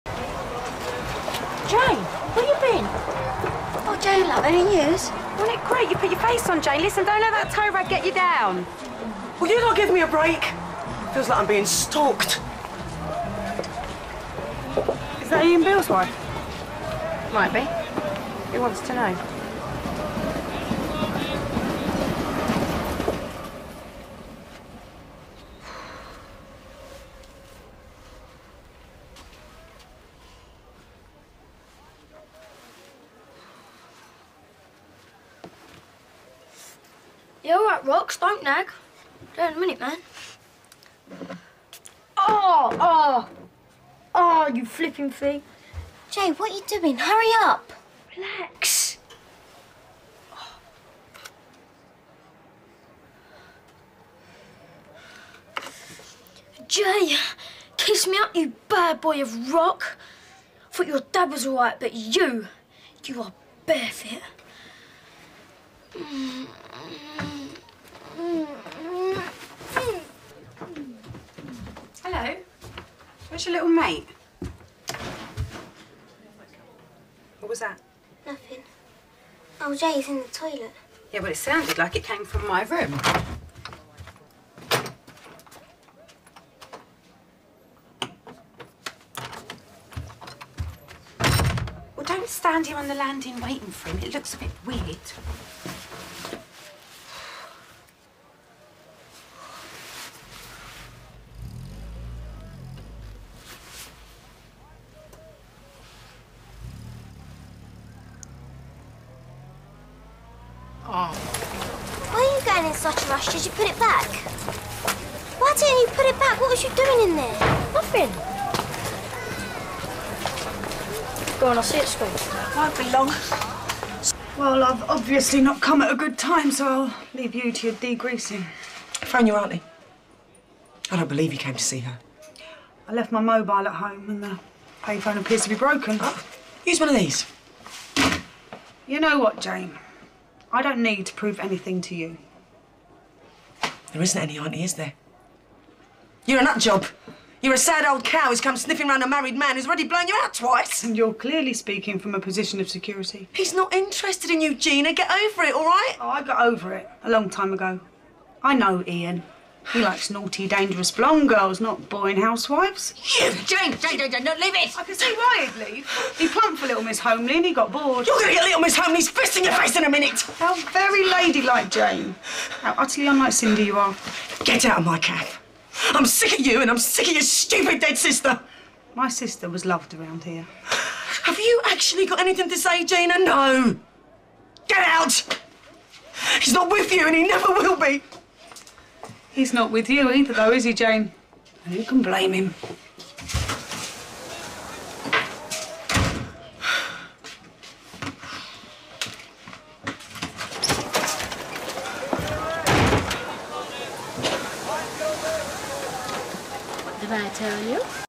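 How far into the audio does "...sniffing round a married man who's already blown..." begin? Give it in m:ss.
2:28.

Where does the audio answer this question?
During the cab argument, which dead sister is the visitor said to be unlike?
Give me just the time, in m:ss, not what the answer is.
2:53.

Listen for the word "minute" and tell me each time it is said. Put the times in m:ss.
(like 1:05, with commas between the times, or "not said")
0:39, 2:49.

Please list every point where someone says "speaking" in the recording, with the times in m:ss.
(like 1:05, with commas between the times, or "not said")
2:31.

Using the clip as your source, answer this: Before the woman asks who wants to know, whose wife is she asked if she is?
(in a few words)
Ian Beale's.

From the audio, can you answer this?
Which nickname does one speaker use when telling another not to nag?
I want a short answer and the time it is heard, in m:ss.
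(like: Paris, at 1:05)
Rocks, at 0:37.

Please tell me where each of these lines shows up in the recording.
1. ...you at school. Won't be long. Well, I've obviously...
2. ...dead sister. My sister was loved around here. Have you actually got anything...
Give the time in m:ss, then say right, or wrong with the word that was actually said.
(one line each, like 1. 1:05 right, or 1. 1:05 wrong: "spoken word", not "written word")
1. 2:01 right
2. 2:57 right.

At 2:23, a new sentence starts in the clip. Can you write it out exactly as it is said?
There isn't any auntie, is there?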